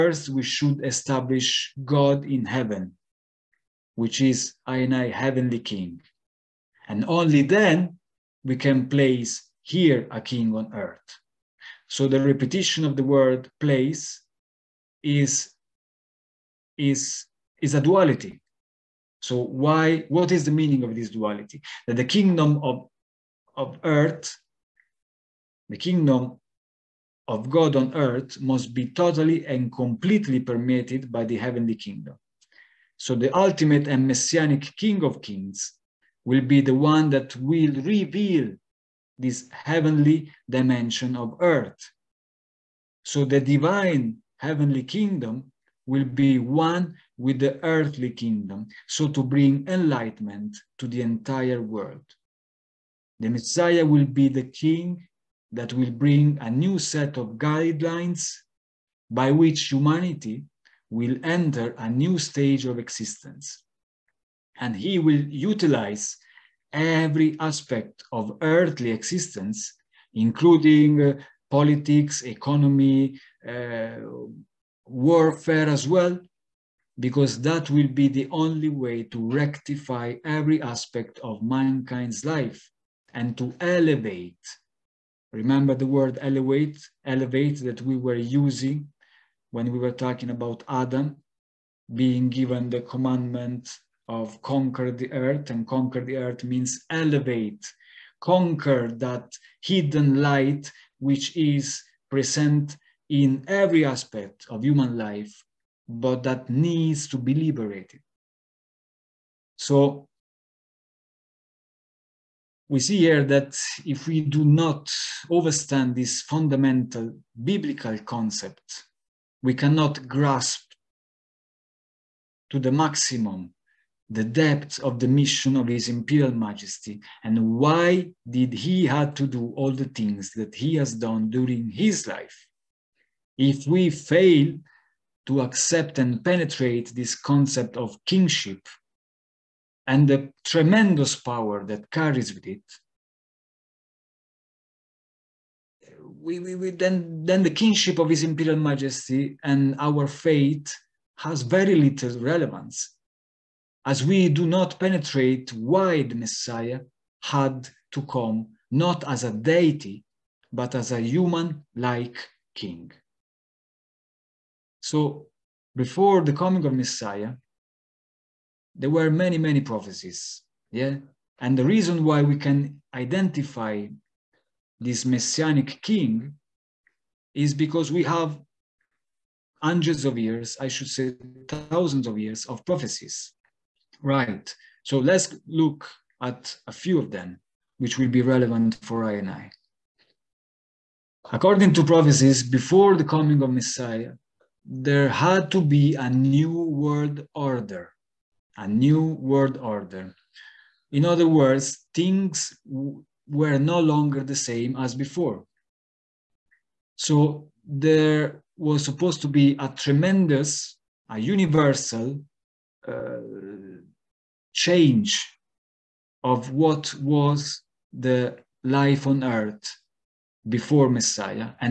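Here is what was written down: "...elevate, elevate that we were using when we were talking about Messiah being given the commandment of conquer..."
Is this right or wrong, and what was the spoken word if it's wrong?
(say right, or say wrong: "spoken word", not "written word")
wrong: "Adam", not "Messiah".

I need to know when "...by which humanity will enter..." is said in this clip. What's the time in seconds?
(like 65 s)
59 s.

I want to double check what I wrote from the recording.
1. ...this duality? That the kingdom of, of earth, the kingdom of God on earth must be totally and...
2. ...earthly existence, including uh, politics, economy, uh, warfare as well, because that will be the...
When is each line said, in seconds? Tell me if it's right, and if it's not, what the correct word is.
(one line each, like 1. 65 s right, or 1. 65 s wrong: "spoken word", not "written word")
1. 20 s right
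2. 68 s right.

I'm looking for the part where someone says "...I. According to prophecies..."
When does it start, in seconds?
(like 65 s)
189 s.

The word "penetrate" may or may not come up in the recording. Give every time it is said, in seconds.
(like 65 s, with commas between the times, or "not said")
136 s, 154 s.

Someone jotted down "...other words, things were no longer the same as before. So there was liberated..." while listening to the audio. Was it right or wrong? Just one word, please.
wrong.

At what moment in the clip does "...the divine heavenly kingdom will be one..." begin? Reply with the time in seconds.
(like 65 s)
43 s.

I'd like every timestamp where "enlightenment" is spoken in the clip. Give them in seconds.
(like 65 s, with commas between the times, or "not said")
49 s.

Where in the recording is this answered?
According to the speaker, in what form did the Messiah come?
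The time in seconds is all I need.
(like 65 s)
160 s.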